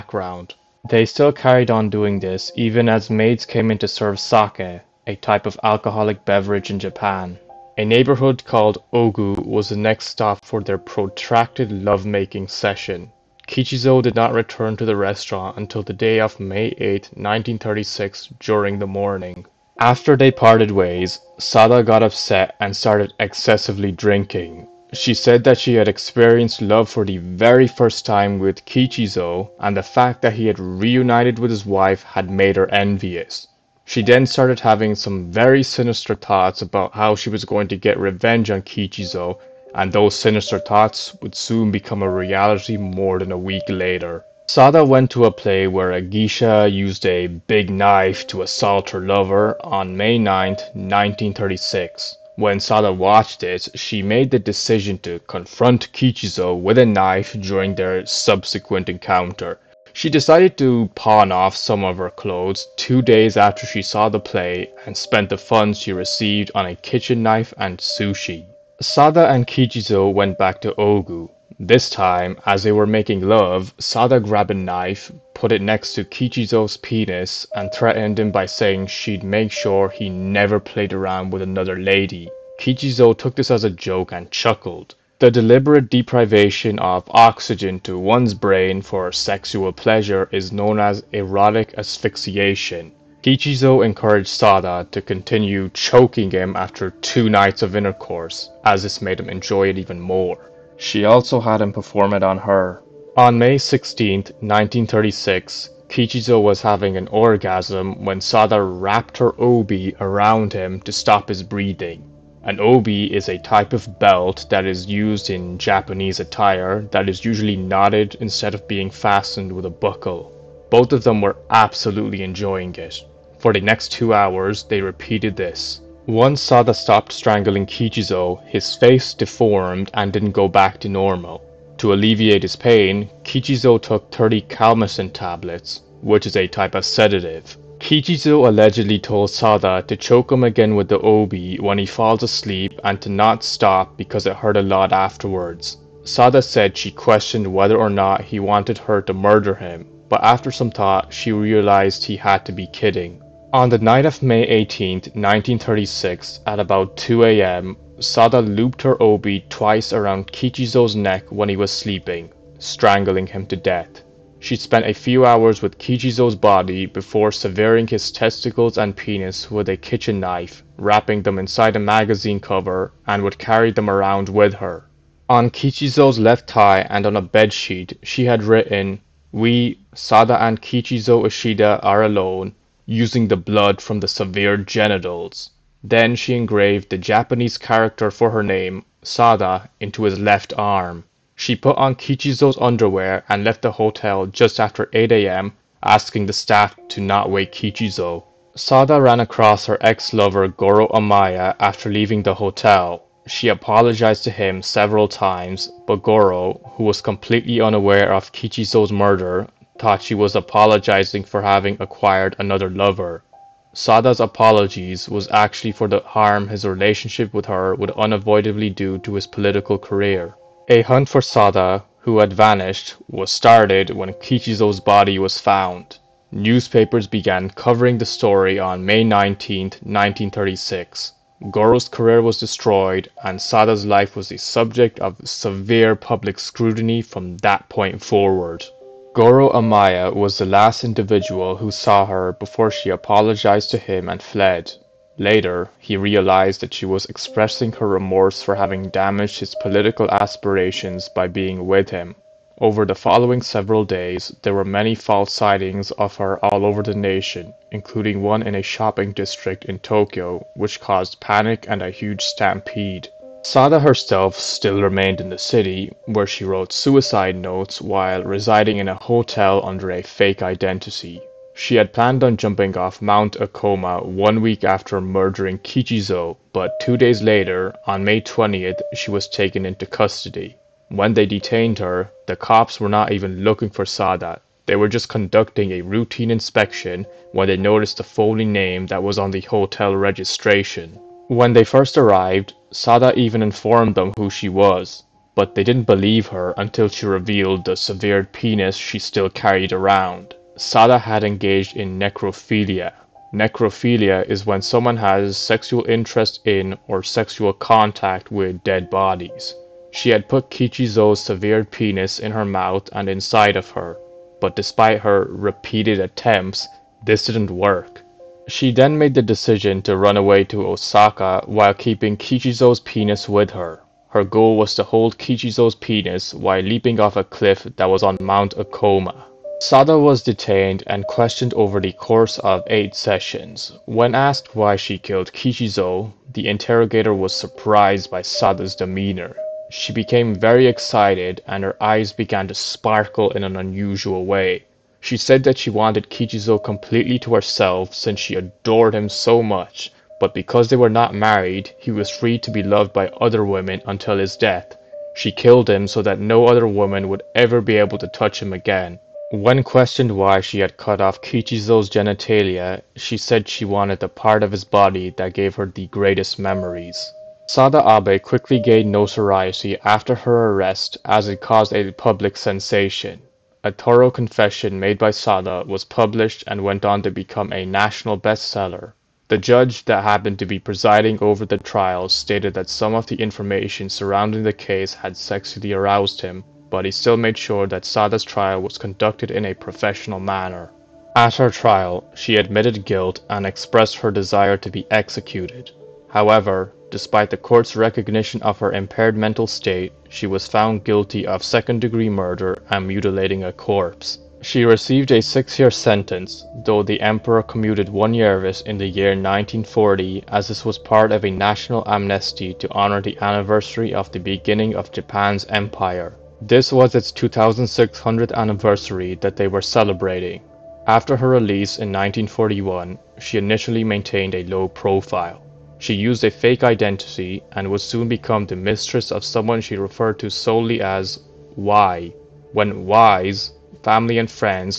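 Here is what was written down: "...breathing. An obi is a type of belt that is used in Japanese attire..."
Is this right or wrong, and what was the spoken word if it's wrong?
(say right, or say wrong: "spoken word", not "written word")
right.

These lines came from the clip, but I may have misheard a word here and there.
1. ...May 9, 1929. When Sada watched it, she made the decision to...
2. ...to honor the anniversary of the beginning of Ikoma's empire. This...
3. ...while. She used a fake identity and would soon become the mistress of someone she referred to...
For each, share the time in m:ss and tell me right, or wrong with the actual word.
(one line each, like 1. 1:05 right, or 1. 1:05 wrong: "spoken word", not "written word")
1. 0:49 wrong: "1936", not "1929"
2. 6:52 wrong: "Japan", not "Ikoma"
3. 7:04 wrong: "profile", not "while".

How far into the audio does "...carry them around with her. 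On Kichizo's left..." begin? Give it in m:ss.
2:53.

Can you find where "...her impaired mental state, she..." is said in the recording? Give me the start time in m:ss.
6:38.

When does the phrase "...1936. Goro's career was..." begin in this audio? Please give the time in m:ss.
3:49.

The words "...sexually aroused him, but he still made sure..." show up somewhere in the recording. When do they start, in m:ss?
6:25.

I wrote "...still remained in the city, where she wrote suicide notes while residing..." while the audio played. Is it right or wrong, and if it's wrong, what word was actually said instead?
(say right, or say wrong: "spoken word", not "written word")
right.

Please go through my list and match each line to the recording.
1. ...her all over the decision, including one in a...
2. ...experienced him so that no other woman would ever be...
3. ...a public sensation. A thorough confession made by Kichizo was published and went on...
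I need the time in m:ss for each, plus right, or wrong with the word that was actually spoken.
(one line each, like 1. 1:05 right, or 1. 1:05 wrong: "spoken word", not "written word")
1. 4:16 wrong: "nation", not "decision"
2. 5:55 wrong: "killed", not "experienced"
3. 6:11 wrong: "Sada", not "Kichizo".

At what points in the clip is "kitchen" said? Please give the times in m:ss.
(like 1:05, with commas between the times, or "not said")
1:06, 2:49.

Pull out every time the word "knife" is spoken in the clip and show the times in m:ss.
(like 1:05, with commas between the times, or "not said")
0:47, 0:56, 1:07, 1:14, 2:50.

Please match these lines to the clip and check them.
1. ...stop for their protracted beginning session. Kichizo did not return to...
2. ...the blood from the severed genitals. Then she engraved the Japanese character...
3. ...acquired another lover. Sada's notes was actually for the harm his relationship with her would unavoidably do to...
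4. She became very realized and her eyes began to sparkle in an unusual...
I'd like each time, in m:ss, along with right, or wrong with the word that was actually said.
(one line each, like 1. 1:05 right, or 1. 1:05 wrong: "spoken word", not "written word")
1. 0:10 wrong: "lovemaking", not "beginning"
2. 3:03 right
3. 3:31 wrong: "apologies", not "notes"
4. 5:39 wrong: "excited", not "realized".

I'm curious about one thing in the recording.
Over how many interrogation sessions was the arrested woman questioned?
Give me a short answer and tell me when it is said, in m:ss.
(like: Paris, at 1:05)
8, at 5:32.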